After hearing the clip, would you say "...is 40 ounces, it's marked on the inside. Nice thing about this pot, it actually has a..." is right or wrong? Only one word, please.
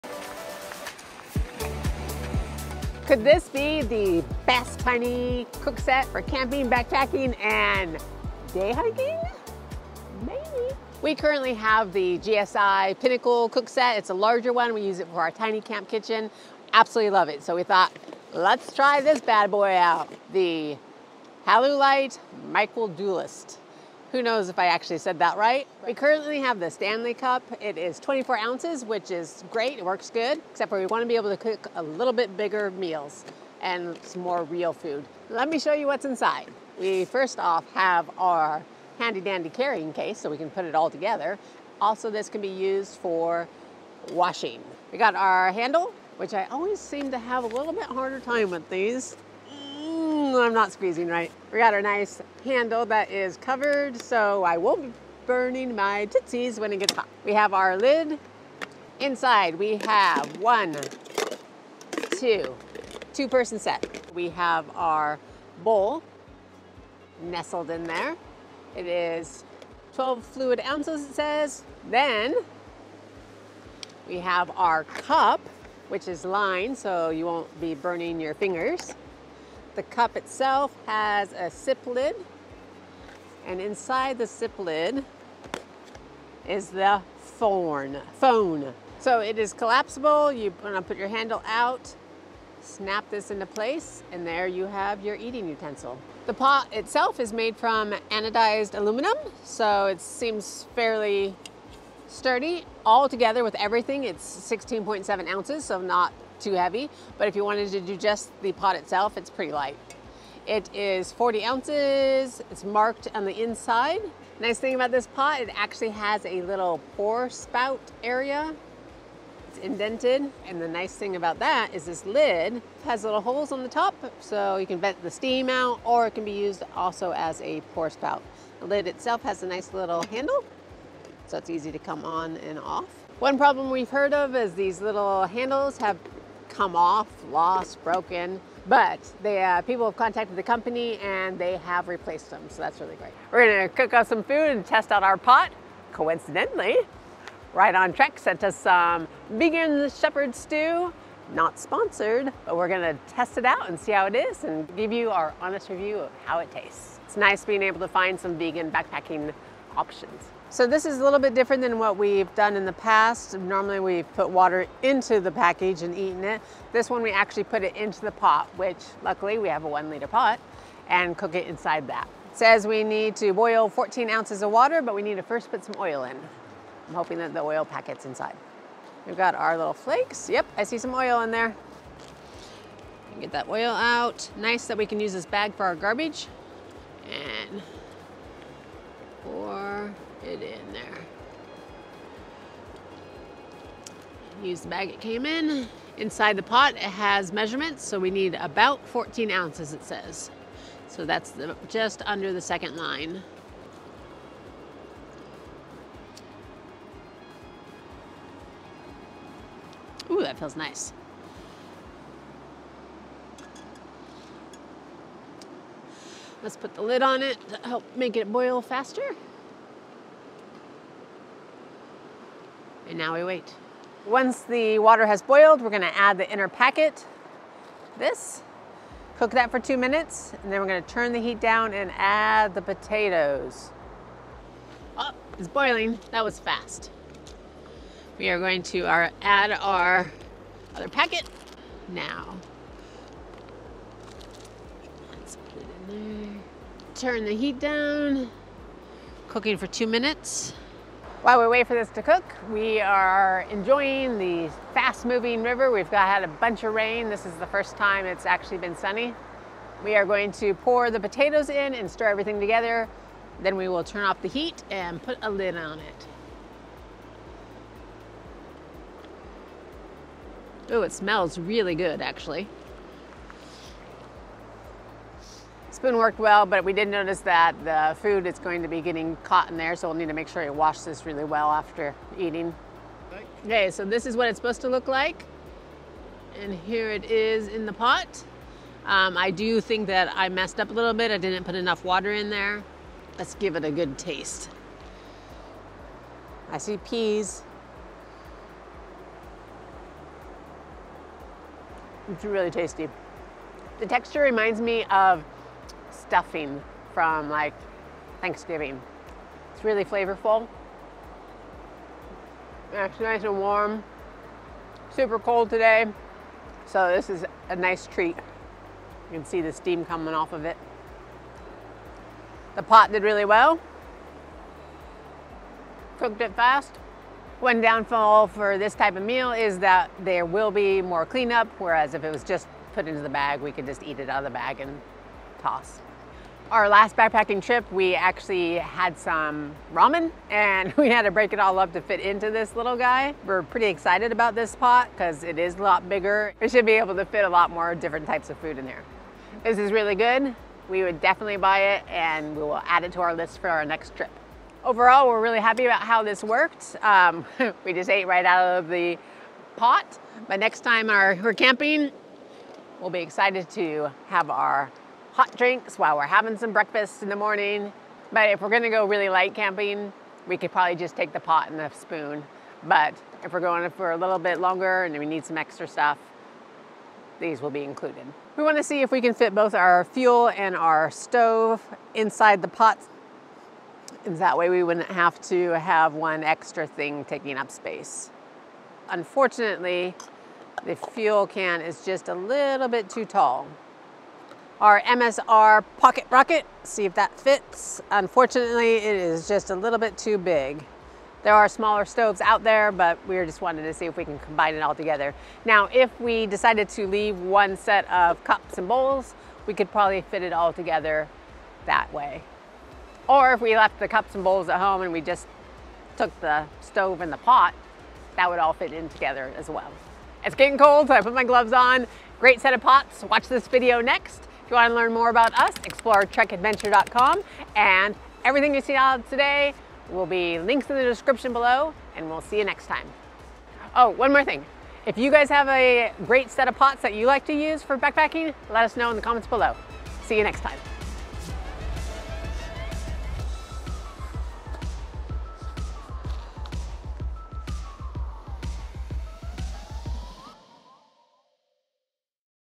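right.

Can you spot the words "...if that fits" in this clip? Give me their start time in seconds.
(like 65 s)
396 s.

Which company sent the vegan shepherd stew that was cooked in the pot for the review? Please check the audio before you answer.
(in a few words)
RightOnTrek.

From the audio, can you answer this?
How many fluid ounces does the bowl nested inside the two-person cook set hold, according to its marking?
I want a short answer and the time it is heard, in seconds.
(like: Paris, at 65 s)
12, at 69 s.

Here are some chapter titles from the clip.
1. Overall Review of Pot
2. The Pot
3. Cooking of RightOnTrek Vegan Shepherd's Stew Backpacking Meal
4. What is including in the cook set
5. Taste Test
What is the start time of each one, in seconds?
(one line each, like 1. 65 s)
1. 354 s
2. 96 s
3. 147 s
4. 35 s
5. 296 s.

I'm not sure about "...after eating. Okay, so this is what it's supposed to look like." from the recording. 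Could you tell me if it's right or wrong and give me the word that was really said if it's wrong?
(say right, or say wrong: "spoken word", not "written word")
right.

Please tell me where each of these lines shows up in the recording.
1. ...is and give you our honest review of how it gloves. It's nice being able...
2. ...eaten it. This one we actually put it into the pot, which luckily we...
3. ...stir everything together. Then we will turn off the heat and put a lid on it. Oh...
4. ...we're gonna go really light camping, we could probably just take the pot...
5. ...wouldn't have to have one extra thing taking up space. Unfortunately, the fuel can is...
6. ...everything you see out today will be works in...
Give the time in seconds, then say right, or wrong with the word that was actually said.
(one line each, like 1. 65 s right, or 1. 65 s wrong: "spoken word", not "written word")
1. 154 s wrong: "tastes", not "gloves"
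2. 165 s right
3. 261 s right
4. 368 s right
5. 384 s right
6. 428 s wrong: "links", not "works".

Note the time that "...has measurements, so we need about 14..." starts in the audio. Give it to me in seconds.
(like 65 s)
196 s.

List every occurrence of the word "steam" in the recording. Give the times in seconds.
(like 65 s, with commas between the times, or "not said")
125 s, 319 s.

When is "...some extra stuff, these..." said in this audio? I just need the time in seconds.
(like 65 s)
375 s.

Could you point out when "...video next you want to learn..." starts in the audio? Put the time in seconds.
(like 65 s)
423 s.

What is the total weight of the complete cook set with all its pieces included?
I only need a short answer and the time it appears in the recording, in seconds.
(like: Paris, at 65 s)
16.7 ounces, at 104 s.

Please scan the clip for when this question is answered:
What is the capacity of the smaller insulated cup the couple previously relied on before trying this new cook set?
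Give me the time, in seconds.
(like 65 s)
27 s.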